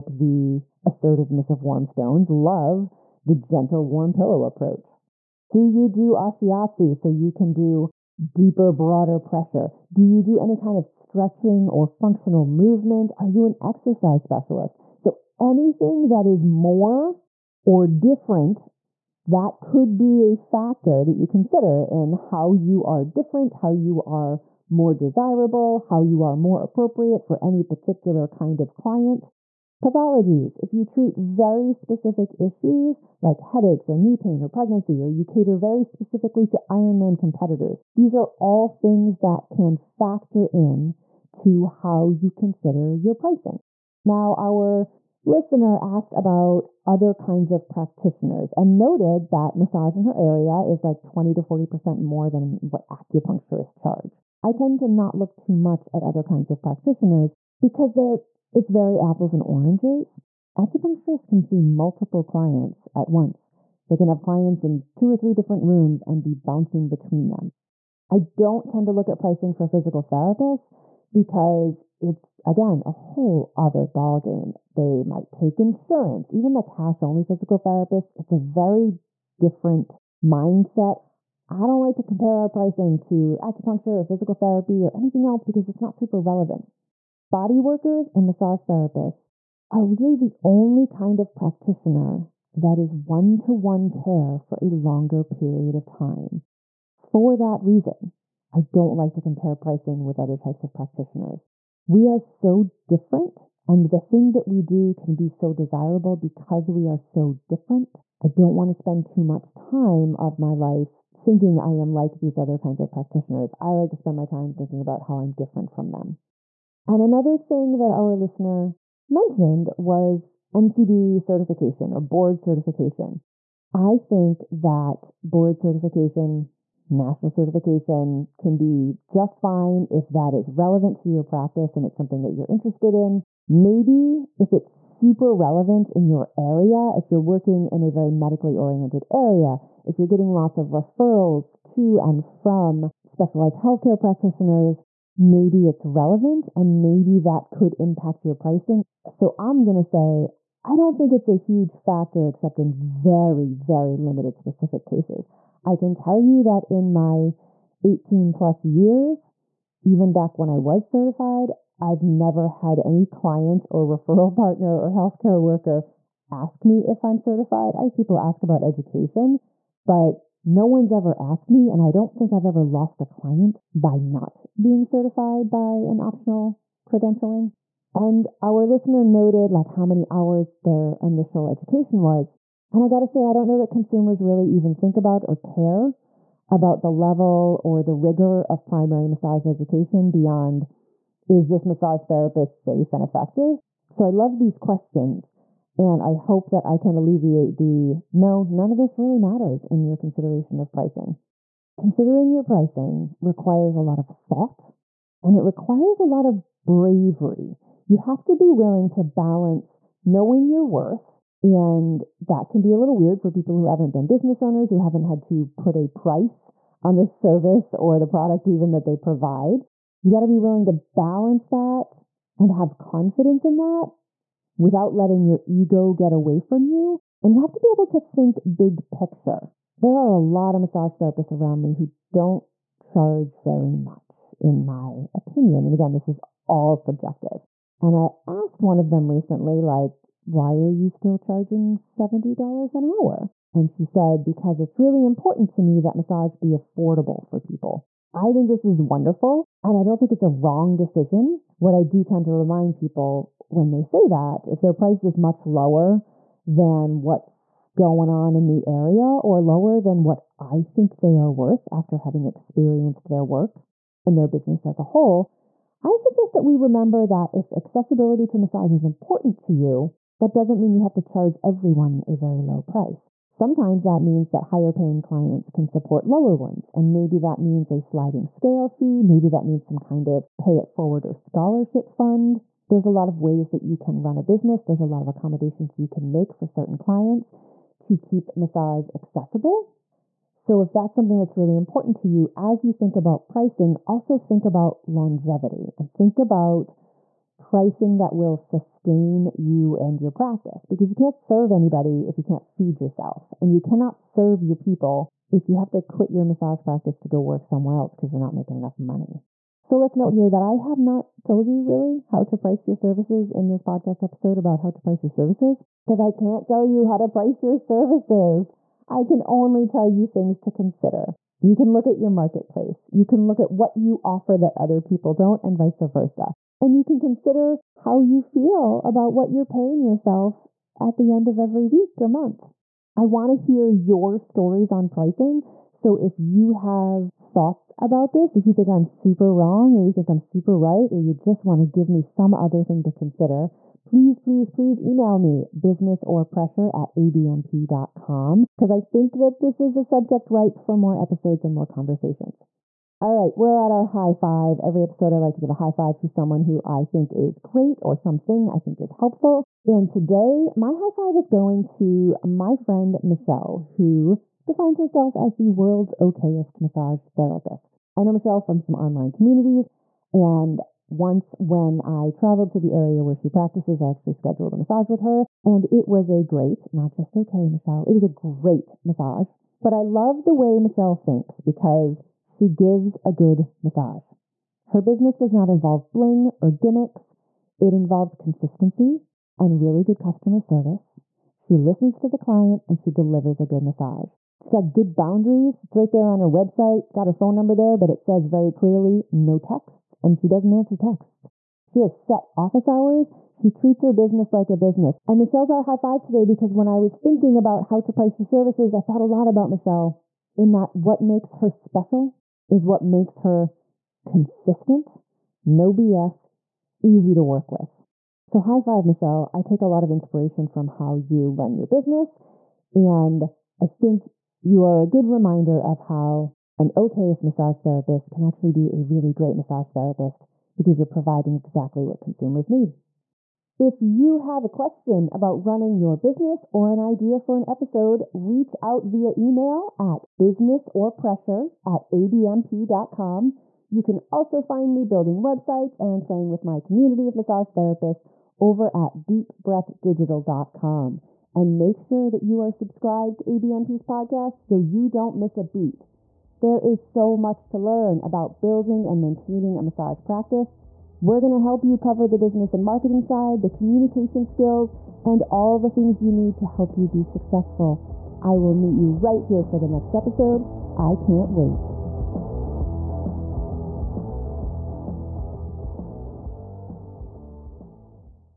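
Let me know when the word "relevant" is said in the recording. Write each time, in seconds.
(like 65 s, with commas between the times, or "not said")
86 s, 130 s, 135 s, 145 s.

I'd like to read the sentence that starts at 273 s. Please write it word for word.
Sometimes that means that higher paying clients can support lower ones.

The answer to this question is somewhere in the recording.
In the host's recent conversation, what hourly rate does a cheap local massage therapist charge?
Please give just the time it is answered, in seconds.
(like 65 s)
241 s.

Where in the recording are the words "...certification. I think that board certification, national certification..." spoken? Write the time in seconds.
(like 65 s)
122 s.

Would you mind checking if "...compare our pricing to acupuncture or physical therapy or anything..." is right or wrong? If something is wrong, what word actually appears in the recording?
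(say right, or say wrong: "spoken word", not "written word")
right.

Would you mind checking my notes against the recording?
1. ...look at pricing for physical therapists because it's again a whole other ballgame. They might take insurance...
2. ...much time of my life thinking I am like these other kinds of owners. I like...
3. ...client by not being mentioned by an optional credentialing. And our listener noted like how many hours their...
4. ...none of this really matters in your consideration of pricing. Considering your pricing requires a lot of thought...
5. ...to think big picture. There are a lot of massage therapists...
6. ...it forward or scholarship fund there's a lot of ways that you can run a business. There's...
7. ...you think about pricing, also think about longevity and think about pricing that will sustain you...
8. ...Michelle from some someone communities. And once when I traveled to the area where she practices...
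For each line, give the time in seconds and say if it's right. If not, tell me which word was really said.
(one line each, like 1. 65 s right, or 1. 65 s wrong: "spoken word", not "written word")
1. 68 s right
2. 109 s wrong: "practitioners", not "owners"
3. 173 s wrong: "certified", not "mentioned"
4. 198 s right
5. 227 s right
6. 280 s right
7. 292 s right
8. 368 s wrong: "online", not "someone".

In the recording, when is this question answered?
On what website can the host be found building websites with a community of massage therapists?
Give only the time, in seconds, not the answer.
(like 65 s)
449 s.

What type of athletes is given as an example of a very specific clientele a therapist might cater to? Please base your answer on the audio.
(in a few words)
Ironman competitors.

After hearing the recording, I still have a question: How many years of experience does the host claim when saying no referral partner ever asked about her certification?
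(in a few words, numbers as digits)
18.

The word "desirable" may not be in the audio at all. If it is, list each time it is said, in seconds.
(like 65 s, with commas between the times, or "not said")
24 s, 105 s.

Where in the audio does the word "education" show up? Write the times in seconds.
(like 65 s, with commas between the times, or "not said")
168 s, 181 s, 189 s.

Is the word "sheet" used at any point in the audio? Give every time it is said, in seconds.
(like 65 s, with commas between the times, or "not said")
not said.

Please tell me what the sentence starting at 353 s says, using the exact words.
All right, we're at our high five.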